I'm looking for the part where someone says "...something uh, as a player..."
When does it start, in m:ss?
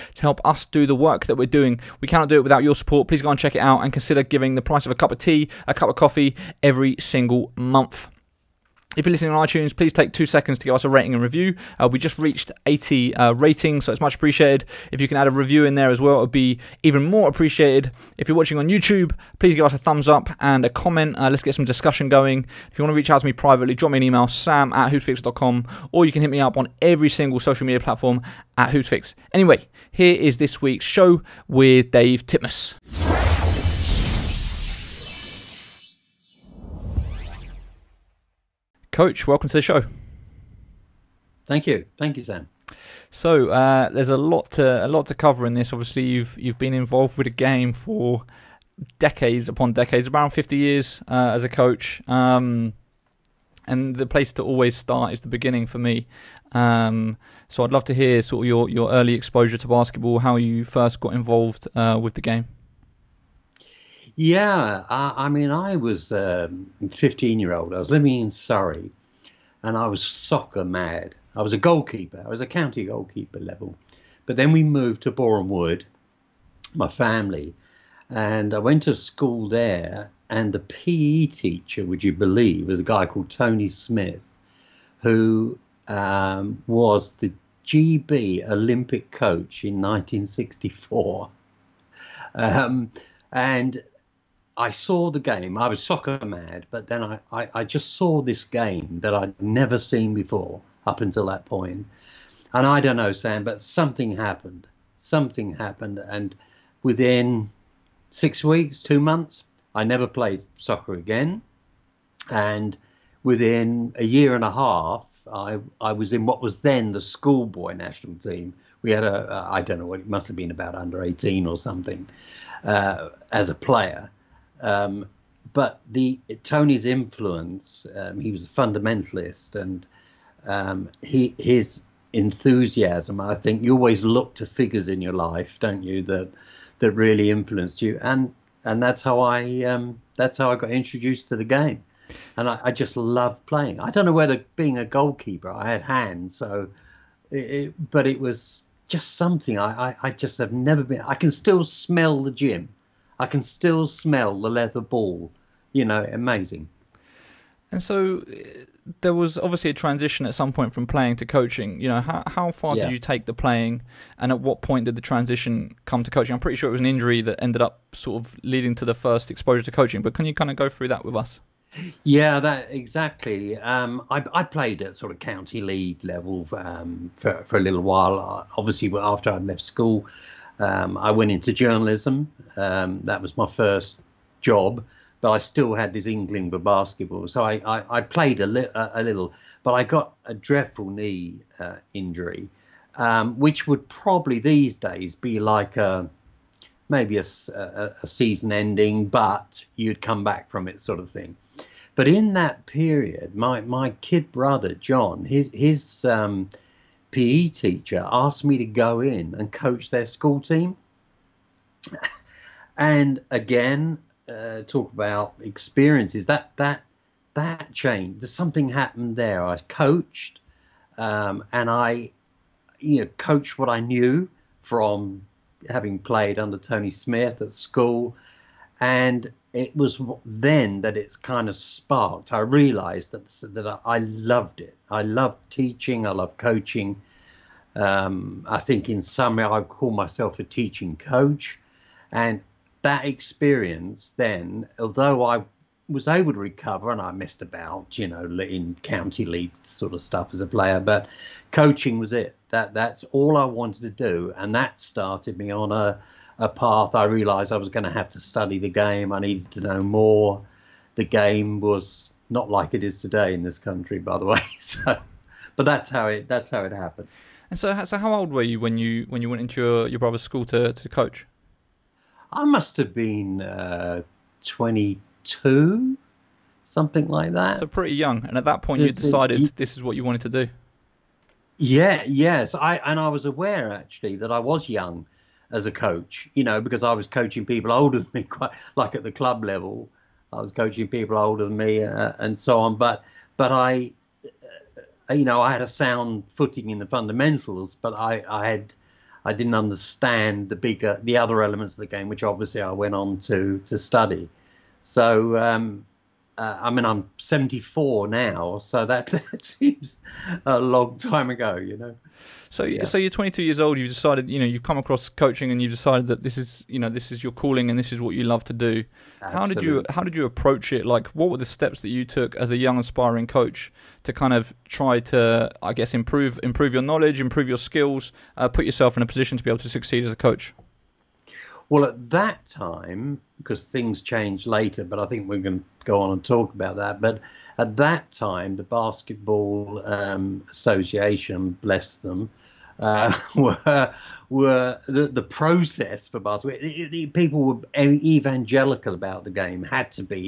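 2:01.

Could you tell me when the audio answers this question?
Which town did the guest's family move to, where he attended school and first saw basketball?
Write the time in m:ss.
1:15.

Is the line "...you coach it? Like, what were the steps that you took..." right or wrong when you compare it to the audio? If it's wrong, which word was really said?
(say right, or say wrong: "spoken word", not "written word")
wrong: "approach", not "coach".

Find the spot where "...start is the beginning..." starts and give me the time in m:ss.
0:54.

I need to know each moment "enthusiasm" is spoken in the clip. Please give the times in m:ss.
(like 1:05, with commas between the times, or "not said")
2:12.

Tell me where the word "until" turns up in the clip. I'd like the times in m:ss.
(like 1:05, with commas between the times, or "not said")
1:40.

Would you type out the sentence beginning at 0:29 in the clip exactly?
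Anyway, here is this week's show with Dave Titmuss.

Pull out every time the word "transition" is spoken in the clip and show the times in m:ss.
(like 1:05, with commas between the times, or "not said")
2:39, 2:45.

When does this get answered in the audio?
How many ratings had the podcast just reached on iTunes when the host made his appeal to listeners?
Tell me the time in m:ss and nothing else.
0:12.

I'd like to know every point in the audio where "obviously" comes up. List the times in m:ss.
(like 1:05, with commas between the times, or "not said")
0:45, 2:39, 2:58, 5:02.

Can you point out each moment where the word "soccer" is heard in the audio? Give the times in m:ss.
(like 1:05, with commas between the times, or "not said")
1:10, 1:35, 1:50.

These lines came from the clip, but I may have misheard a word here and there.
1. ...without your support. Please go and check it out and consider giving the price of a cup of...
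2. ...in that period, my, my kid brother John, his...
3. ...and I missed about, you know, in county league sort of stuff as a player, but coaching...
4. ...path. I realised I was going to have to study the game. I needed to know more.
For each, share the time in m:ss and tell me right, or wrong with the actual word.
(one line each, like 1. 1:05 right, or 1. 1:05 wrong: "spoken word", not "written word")
1. 0:02 right
2. 3:22 right
3. 4:06 right
4. 4:16 right.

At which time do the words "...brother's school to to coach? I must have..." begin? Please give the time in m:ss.
4:29.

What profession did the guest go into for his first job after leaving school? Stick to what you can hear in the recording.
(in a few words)
Journalism.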